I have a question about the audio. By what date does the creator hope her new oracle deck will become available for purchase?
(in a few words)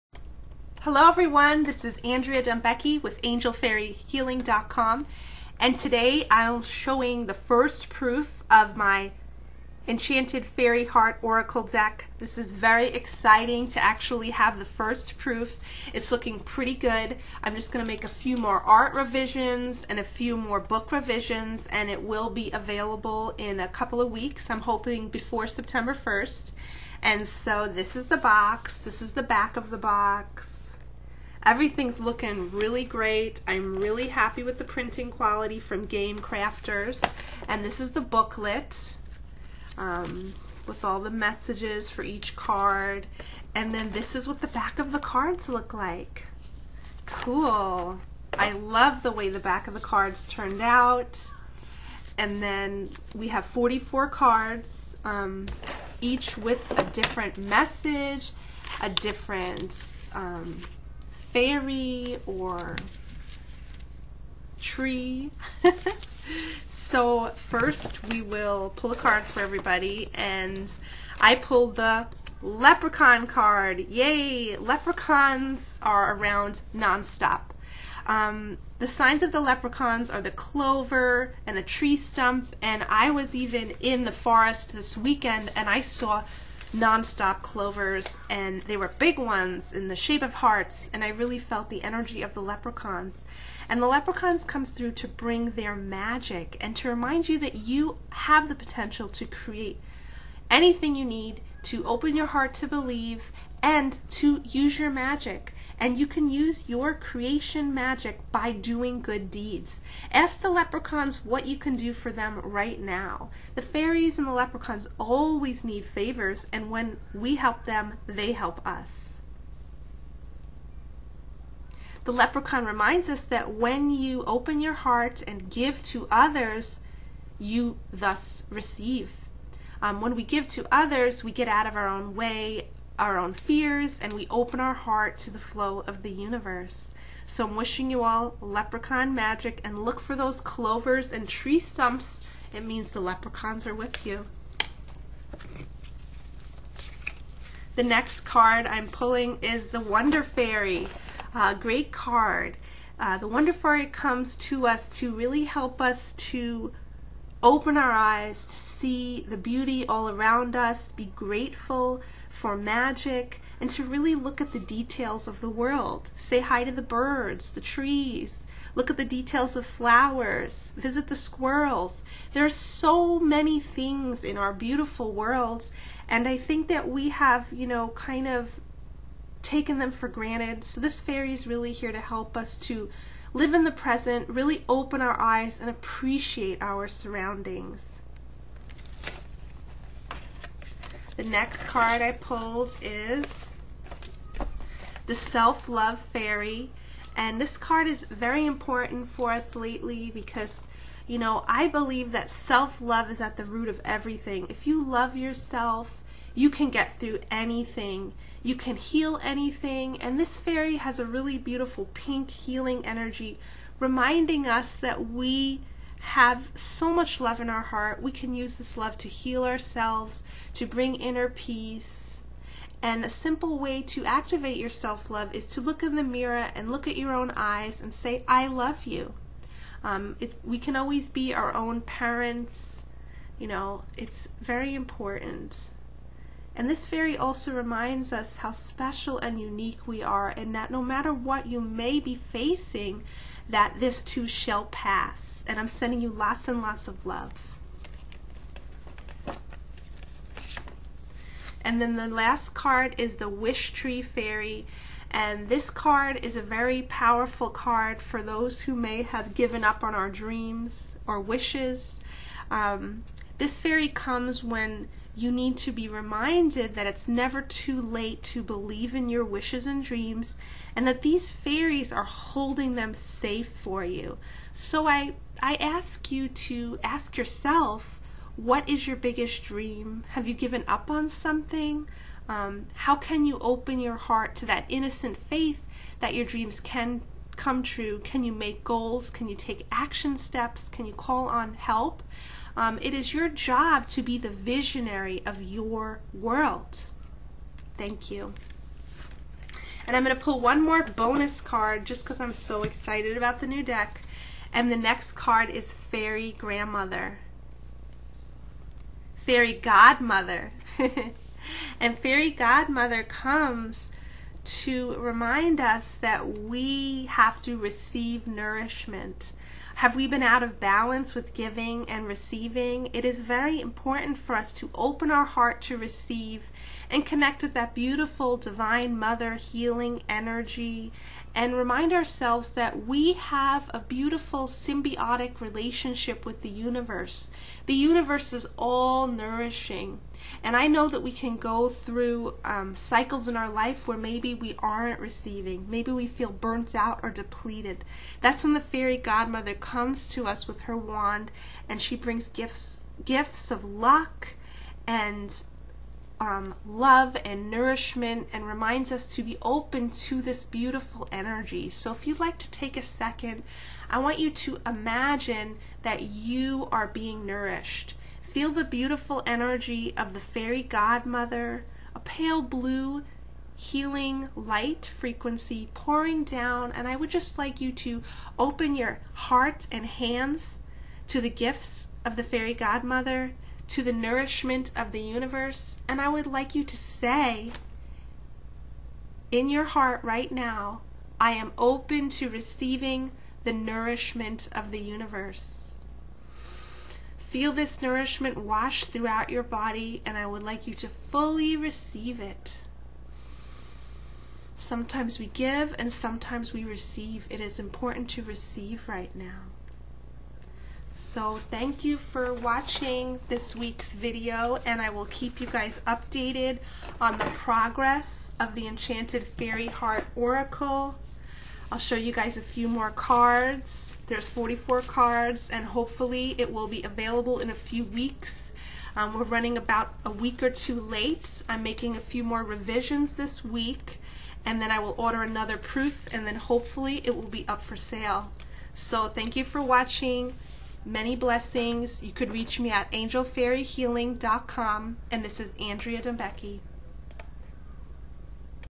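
September 1st.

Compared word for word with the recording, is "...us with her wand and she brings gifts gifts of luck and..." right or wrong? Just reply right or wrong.
right.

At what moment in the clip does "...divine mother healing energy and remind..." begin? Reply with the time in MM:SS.
05:28.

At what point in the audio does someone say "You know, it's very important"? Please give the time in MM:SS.
03:53.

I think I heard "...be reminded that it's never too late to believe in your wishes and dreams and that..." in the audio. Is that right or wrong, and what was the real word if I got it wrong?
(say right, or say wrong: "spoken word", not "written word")
right.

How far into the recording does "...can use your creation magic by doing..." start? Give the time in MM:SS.
01:46.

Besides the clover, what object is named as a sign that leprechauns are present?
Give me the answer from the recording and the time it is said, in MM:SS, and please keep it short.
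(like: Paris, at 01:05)
A tree stump, at 01:21.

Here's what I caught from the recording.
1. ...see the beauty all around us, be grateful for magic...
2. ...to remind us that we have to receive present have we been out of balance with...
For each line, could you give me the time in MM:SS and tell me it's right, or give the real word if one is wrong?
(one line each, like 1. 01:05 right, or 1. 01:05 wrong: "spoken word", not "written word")
1. 02:38 right
2. 05:14 wrong: "nourishment", not "present".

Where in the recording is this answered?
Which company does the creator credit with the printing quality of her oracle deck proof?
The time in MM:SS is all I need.
00:35.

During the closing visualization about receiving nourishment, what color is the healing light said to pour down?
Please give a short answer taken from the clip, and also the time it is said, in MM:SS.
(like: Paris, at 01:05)
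Pale blue, at 06:11.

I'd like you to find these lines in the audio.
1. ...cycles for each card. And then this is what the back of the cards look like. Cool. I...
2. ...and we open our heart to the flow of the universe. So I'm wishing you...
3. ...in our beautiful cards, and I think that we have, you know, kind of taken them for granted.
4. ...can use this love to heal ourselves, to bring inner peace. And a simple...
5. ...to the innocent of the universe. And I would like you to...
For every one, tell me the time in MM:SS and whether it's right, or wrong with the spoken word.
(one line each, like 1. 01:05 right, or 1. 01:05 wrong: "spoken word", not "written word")
1. 00:41 wrong: "messages", not "cycles"
2. 02:13 right
3. 02:54 wrong: "worlds", not "cards"
4. 03:38 right
5. 06:23 wrong: "nourishment", not "innocent".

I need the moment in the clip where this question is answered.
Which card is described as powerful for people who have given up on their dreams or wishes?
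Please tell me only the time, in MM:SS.
04:13.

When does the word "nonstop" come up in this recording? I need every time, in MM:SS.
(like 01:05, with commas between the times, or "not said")
01:16, 01:26.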